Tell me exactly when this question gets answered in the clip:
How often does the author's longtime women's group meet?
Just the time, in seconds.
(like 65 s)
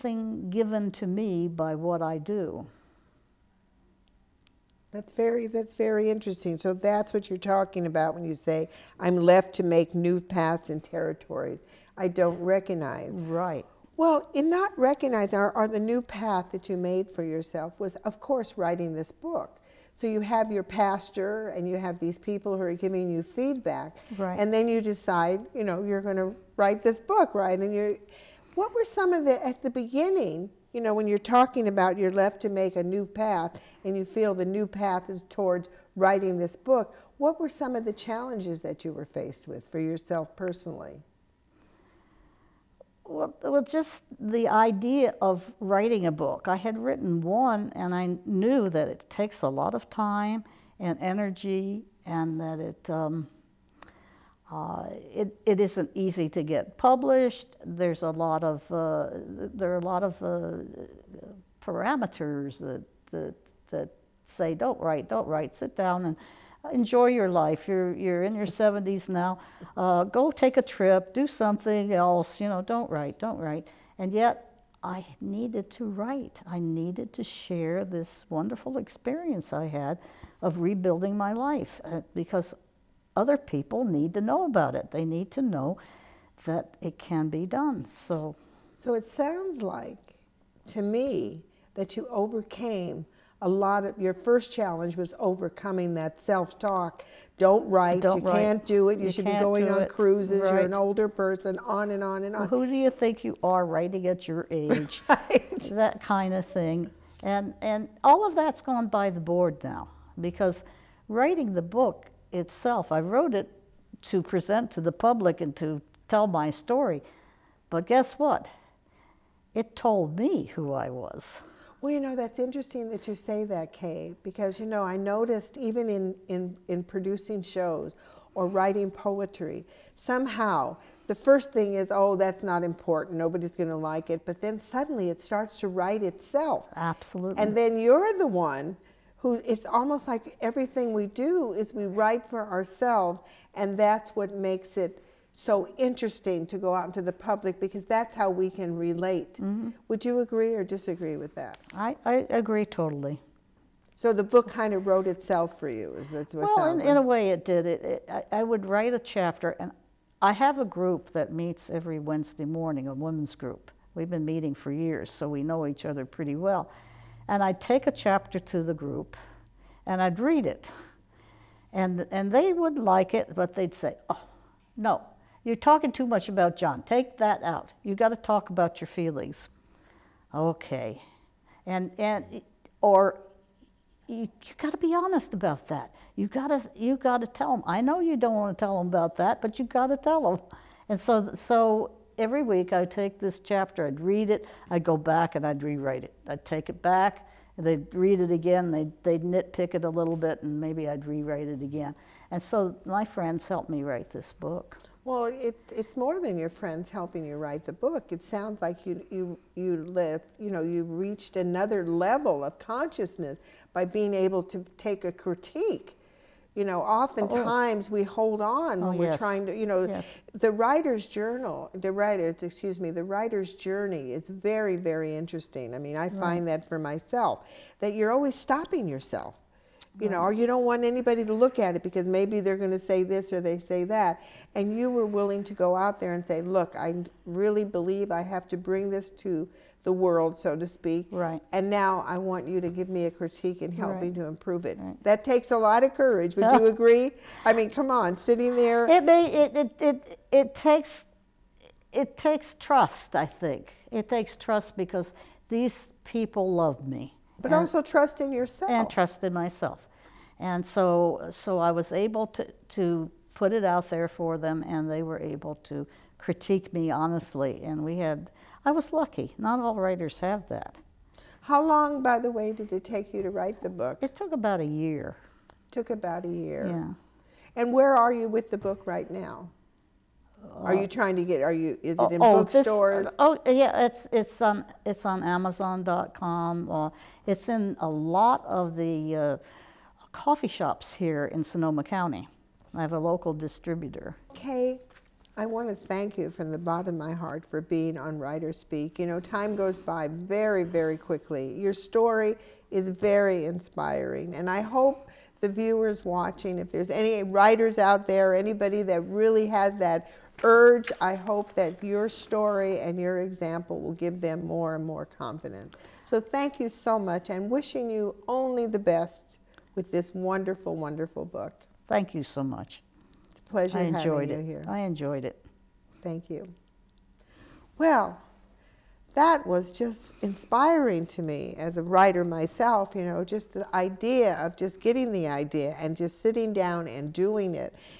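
161 s.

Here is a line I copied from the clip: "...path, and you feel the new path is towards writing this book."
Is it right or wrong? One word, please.
right.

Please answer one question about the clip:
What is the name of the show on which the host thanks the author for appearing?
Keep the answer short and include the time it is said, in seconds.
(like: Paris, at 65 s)
WriterSpeak, at 298 s.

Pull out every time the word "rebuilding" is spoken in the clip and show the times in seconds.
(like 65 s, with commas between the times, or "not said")
80 s.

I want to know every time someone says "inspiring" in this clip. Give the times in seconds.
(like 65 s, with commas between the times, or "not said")
303 s, 330 s.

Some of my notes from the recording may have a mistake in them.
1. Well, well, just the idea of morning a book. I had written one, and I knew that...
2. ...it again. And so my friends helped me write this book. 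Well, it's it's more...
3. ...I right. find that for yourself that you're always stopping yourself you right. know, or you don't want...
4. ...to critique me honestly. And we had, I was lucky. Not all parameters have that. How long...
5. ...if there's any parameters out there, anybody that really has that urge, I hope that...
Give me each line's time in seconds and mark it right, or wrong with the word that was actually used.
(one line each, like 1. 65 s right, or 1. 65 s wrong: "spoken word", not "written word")
1. 43 s wrong: "writing", not "morning"
2. 201 s right
3. 225 s wrong: "myself", not "yourself"
4. 265 s wrong: "writers", not "parameters"
5. 306 s wrong: "writers", not "parameters".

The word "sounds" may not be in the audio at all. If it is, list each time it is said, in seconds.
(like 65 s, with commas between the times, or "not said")
89 s, 208 s.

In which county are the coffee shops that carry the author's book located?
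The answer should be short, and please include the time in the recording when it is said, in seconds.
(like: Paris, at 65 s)
Sonoma County, at 291 s.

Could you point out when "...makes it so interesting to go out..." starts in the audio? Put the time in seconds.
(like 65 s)
144 s.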